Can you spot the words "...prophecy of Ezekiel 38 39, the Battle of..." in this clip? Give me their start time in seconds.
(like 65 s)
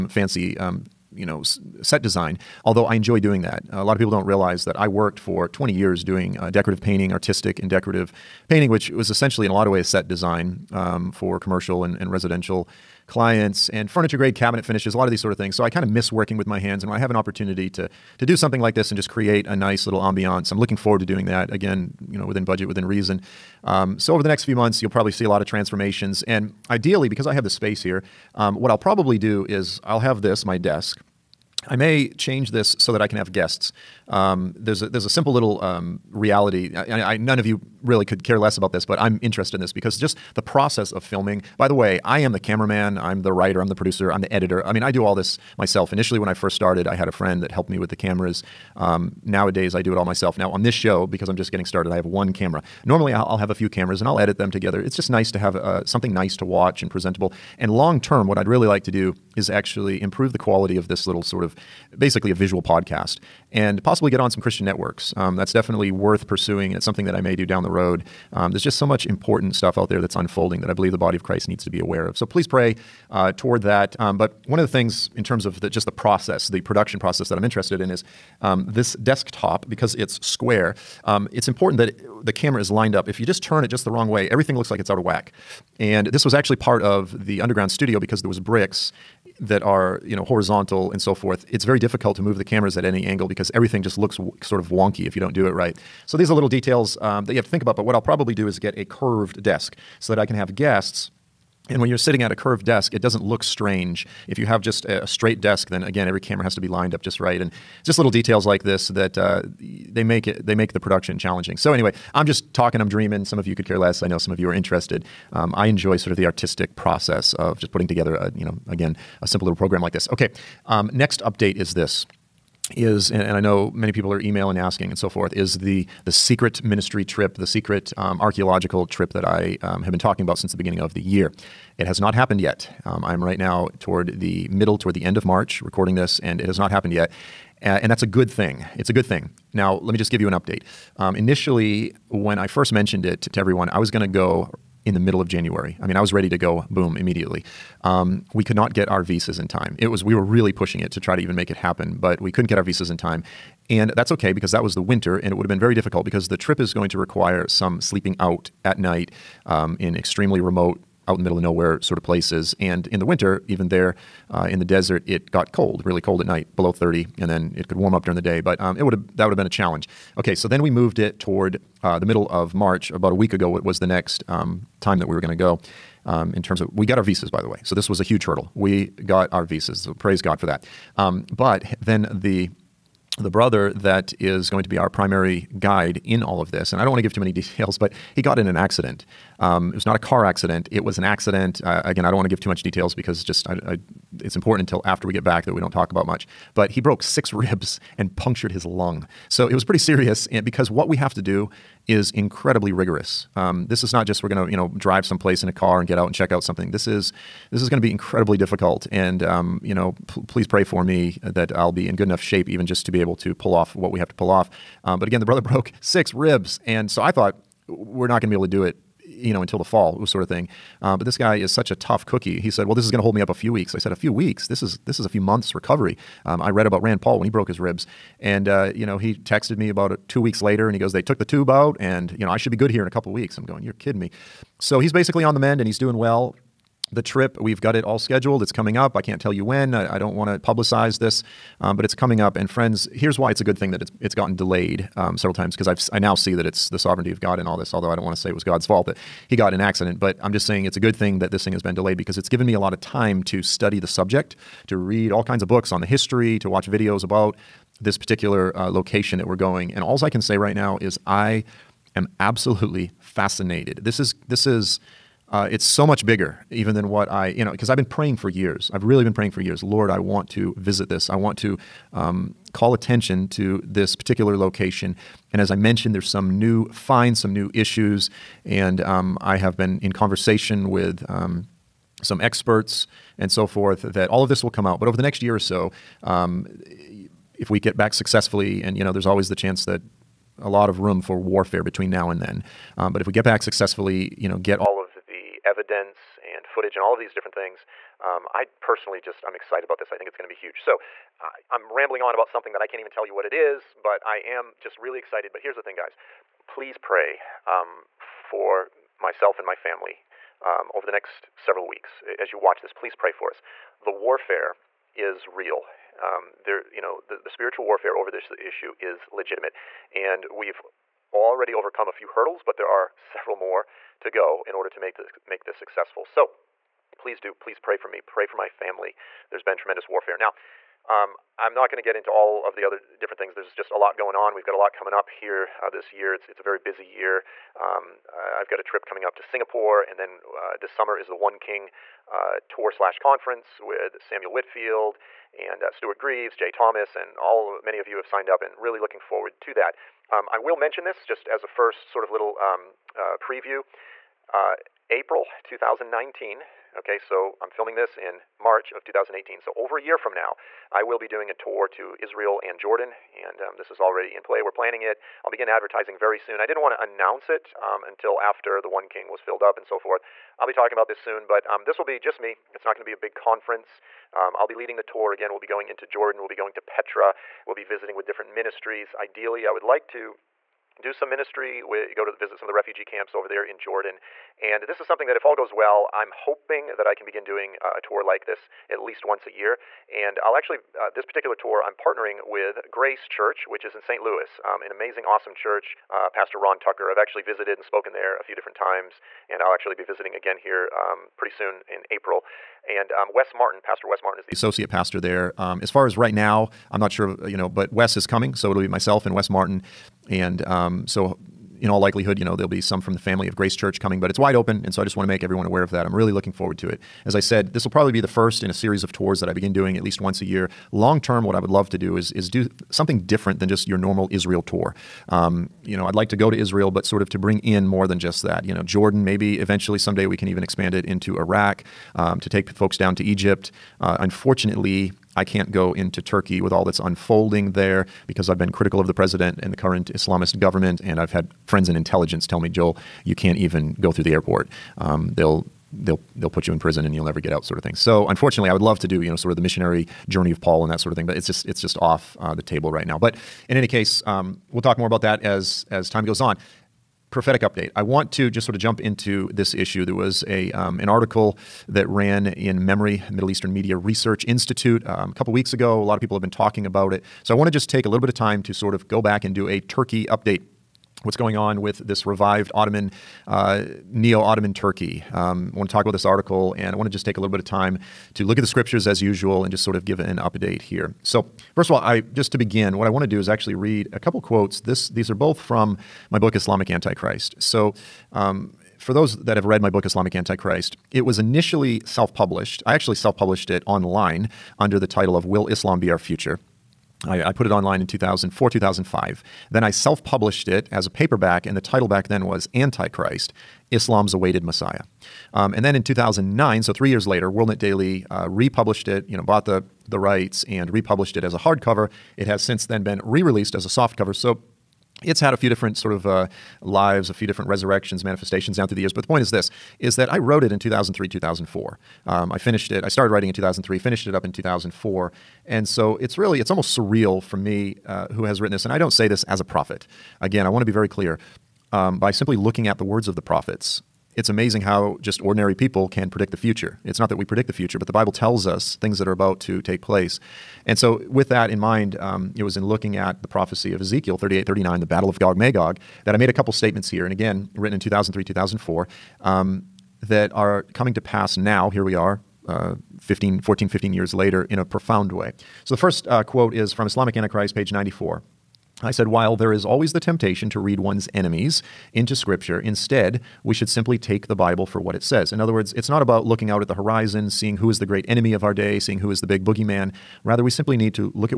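543 s.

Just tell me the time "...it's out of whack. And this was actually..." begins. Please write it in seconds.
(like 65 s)
84 s.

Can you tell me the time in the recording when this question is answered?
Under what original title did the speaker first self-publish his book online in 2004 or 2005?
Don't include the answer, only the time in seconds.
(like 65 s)
495 s.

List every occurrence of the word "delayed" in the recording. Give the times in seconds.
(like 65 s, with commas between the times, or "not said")
244 s, 251 s.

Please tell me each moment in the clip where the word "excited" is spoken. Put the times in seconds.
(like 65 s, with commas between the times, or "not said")
299 s, 304 s.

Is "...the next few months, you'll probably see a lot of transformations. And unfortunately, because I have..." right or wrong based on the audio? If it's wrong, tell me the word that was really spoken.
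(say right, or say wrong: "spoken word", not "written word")
wrong: "ideally", not "unfortunately".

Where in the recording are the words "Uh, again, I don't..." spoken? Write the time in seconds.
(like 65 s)
191 s.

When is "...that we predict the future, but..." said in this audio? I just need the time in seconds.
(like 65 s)
537 s.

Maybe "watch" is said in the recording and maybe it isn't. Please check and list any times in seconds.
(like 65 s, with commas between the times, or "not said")
56 s, 256 s, 312 s.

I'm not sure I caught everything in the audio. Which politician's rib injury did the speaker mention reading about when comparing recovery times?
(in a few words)
Rand Paul.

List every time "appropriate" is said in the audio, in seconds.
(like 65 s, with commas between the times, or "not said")
not said.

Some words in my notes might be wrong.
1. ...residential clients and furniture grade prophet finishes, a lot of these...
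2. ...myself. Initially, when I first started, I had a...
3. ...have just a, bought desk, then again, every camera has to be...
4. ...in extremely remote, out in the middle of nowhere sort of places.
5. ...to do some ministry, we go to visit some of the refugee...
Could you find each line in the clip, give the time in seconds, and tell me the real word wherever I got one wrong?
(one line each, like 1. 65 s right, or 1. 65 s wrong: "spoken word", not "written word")
1. 12 s wrong: "cabinet", not "prophet"
2. 45 s right
3. 104 s wrong: "straight", not "bought"
4. 159 s right
5. 379 s right.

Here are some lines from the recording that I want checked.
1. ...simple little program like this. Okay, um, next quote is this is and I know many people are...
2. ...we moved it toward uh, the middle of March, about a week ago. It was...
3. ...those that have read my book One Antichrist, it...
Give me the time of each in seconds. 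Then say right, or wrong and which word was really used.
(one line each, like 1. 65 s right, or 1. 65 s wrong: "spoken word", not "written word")
1. 119 s wrong: "update", not "quote"
2. 170 s right
3. 488 s wrong: "Islamic", not "One".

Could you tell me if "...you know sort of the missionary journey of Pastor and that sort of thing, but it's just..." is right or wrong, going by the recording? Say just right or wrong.
wrong.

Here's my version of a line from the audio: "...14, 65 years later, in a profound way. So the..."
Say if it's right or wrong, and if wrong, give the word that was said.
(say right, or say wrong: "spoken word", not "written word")
wrong: "15", not "65".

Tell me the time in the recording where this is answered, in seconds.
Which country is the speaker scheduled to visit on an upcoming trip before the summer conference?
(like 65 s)
339 s.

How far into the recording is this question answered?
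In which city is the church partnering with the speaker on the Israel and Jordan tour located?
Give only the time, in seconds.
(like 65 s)
393 s.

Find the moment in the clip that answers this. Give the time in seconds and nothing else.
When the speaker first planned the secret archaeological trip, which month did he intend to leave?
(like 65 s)
144 s.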